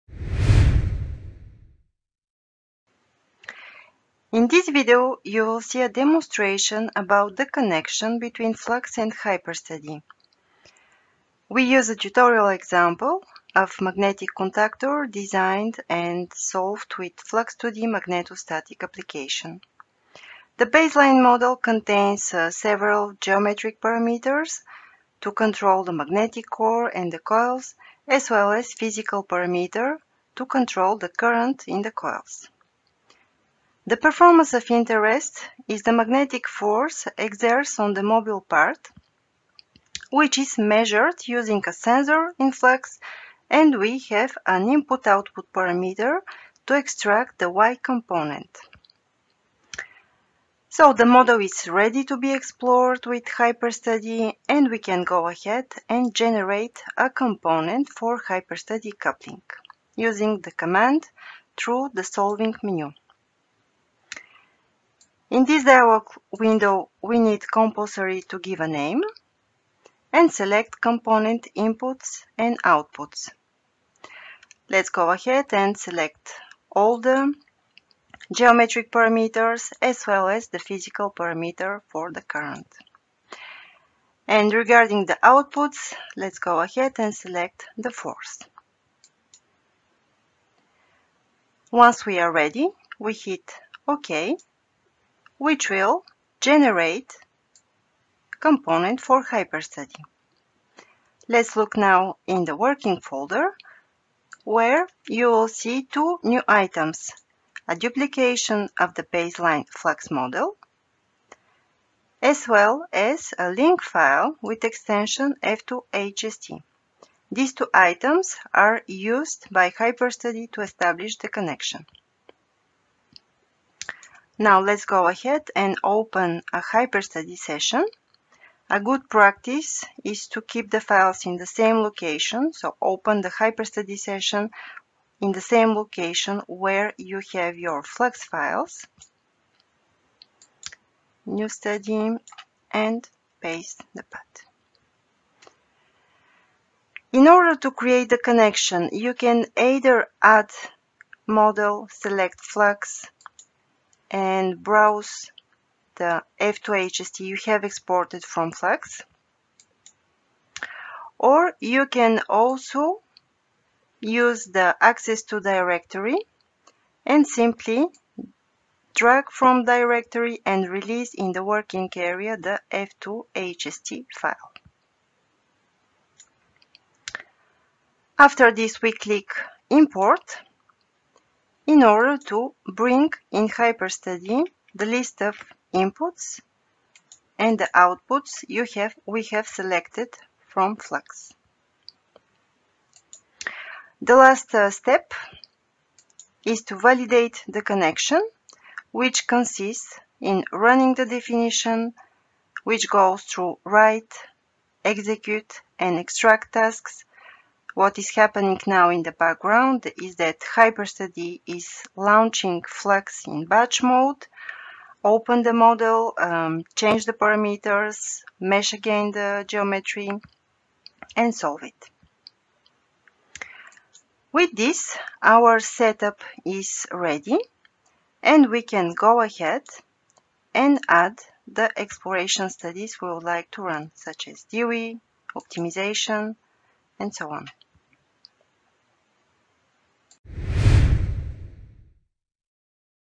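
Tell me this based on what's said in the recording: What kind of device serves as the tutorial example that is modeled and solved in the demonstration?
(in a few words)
Magnetic contactor.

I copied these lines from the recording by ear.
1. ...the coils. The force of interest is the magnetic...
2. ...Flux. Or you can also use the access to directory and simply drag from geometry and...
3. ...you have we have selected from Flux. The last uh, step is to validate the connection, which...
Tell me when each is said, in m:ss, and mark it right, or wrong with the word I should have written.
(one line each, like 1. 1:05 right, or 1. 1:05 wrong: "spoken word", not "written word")
1. 0:31 wrong: "performance", not "force"
2. 2:38 wrong: "directory", not "geometry"
3. 3:08 right.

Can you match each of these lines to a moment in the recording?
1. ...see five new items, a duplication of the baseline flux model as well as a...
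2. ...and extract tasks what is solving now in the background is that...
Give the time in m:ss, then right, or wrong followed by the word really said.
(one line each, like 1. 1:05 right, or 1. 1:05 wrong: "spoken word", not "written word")
1. 1:45 wrong: "two", not "five"
2. 3:25 wrong: "happening", not "solving".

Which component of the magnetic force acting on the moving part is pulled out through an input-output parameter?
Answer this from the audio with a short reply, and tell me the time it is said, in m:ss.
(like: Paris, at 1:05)
Y component, at 0:47.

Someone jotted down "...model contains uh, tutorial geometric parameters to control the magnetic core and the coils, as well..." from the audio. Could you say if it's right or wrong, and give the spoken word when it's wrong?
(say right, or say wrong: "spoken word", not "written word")
wrong: "several", not "tutorial".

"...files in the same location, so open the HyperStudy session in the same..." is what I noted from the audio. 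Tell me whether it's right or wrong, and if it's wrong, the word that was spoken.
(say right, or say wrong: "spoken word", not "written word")
right.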